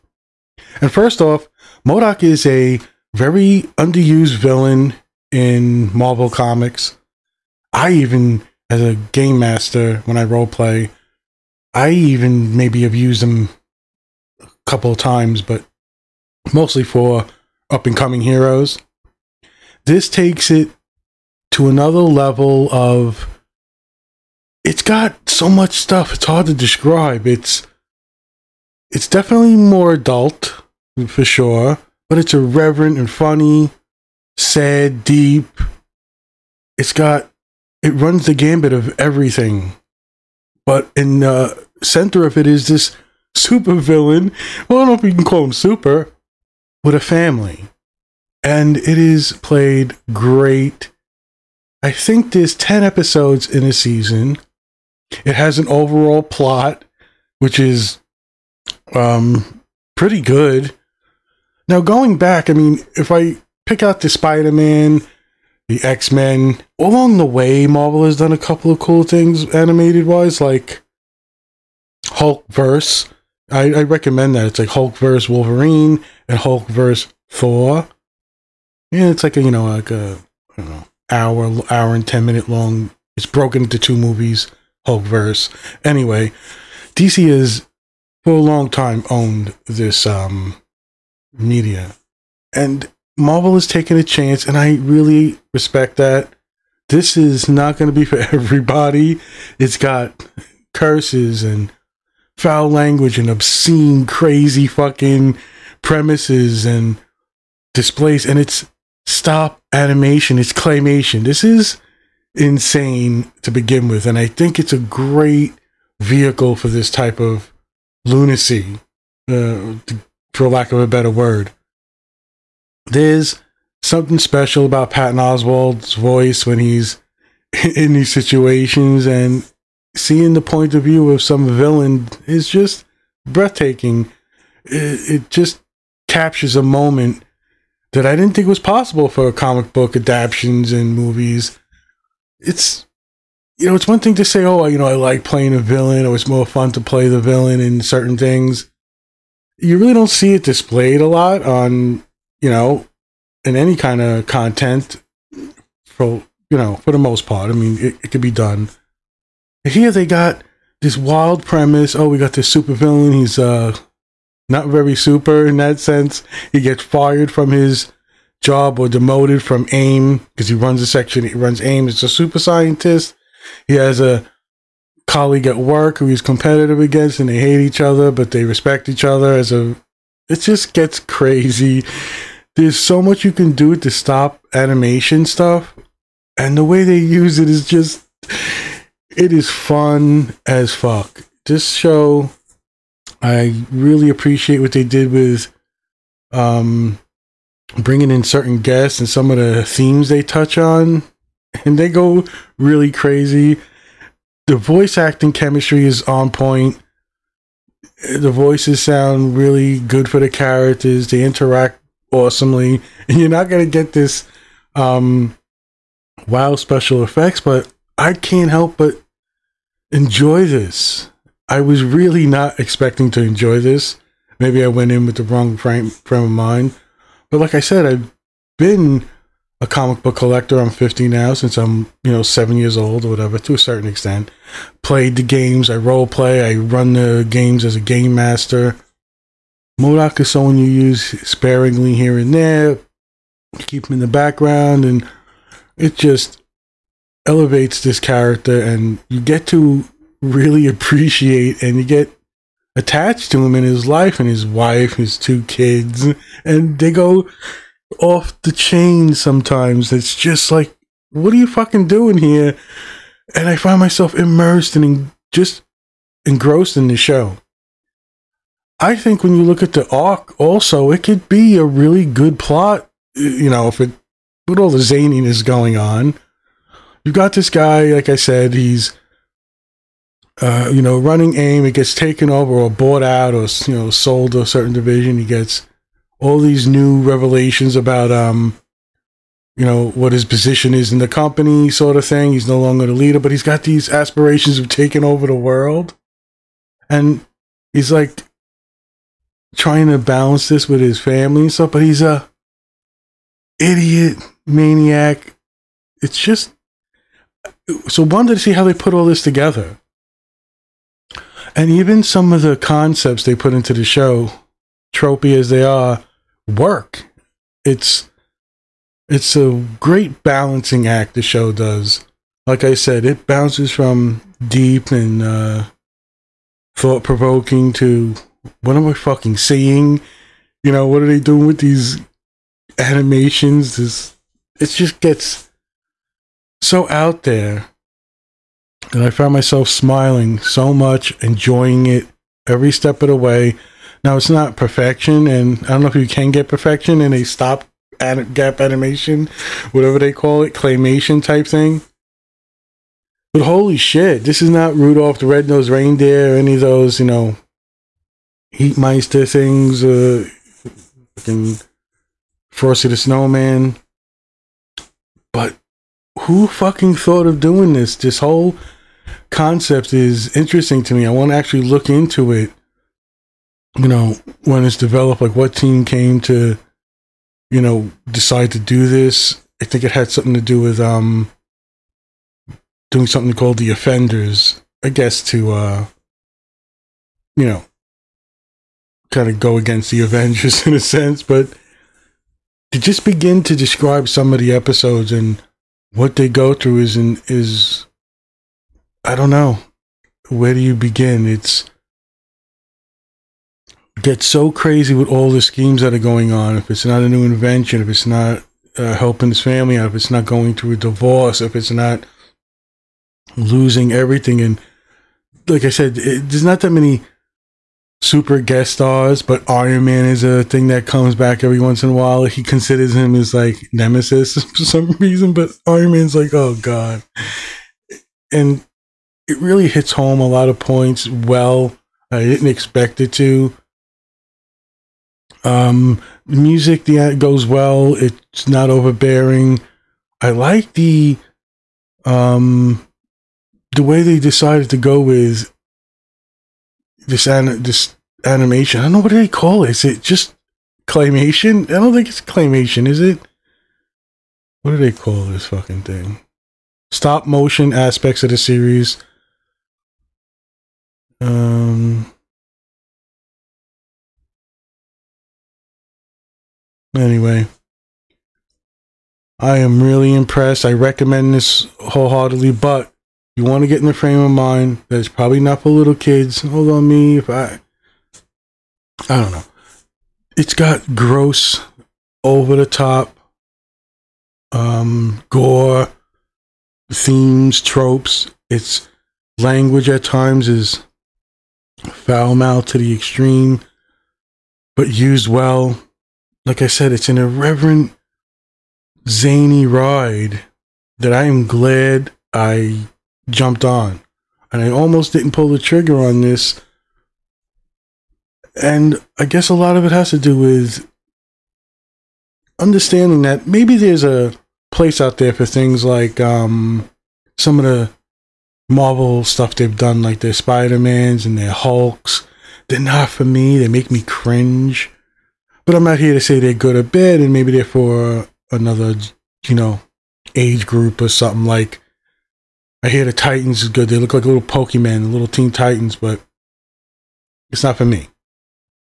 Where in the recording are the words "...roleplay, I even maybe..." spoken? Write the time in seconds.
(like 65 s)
10 s.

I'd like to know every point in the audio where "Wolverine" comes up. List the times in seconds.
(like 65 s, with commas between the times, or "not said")
75 s.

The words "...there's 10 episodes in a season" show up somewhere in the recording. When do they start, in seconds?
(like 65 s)
52 s.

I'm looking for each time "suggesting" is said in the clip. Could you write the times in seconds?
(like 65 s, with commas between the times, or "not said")
not said.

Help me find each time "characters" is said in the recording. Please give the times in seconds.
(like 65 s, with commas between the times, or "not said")
210 s, 247 s.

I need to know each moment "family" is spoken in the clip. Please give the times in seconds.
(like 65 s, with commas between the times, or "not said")
46 s, 300 s, 409 s.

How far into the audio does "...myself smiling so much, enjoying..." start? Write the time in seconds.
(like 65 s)
339 s.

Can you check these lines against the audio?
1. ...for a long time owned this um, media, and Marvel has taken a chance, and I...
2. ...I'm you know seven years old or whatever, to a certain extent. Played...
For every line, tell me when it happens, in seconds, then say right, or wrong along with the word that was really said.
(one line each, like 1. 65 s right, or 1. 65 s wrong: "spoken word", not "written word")
1. 88 s right
2. 231 s right.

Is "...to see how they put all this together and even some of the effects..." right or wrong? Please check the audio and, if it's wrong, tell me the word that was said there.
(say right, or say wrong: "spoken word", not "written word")
wrong: "concepts", not "effects".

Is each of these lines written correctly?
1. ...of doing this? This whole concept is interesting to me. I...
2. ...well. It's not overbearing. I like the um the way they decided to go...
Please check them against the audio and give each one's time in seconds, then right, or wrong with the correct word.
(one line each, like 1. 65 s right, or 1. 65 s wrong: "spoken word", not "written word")
1. 367 s right
2. 437 s right.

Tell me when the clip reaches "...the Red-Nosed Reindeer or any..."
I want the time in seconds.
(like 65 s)
355 s.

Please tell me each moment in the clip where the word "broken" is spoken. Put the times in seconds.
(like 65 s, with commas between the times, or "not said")
83 s.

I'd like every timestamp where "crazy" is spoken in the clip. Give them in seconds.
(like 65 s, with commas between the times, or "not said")
104 s, 180 s, 202 s, 404 s.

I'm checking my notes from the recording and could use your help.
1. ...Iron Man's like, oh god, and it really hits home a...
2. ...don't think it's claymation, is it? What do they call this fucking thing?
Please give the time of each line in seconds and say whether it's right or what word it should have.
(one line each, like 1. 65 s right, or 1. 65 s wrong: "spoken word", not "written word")
1. 425 s right
2. 451 s right.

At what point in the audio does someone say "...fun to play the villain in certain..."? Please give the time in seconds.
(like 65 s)
146 s.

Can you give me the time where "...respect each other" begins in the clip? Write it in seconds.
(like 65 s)
178 s.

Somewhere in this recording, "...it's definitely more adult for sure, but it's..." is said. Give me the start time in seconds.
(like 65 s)
28 s.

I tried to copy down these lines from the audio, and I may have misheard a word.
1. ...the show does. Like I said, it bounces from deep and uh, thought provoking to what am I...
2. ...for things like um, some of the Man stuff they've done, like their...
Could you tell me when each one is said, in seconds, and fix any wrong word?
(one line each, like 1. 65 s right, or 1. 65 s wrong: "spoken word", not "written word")
1. 321 s right
2. 515 s wrong: "Marvel", not "Man".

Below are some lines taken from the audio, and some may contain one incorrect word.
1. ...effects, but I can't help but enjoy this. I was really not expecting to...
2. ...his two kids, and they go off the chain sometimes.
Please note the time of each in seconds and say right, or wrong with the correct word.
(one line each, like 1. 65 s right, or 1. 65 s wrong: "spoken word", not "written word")
1. 217 s right
2. 254 s right.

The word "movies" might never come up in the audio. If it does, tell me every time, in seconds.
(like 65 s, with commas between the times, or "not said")
83 s, 140 s.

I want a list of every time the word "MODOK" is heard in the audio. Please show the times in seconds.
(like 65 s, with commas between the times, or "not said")
1 s, 239 s.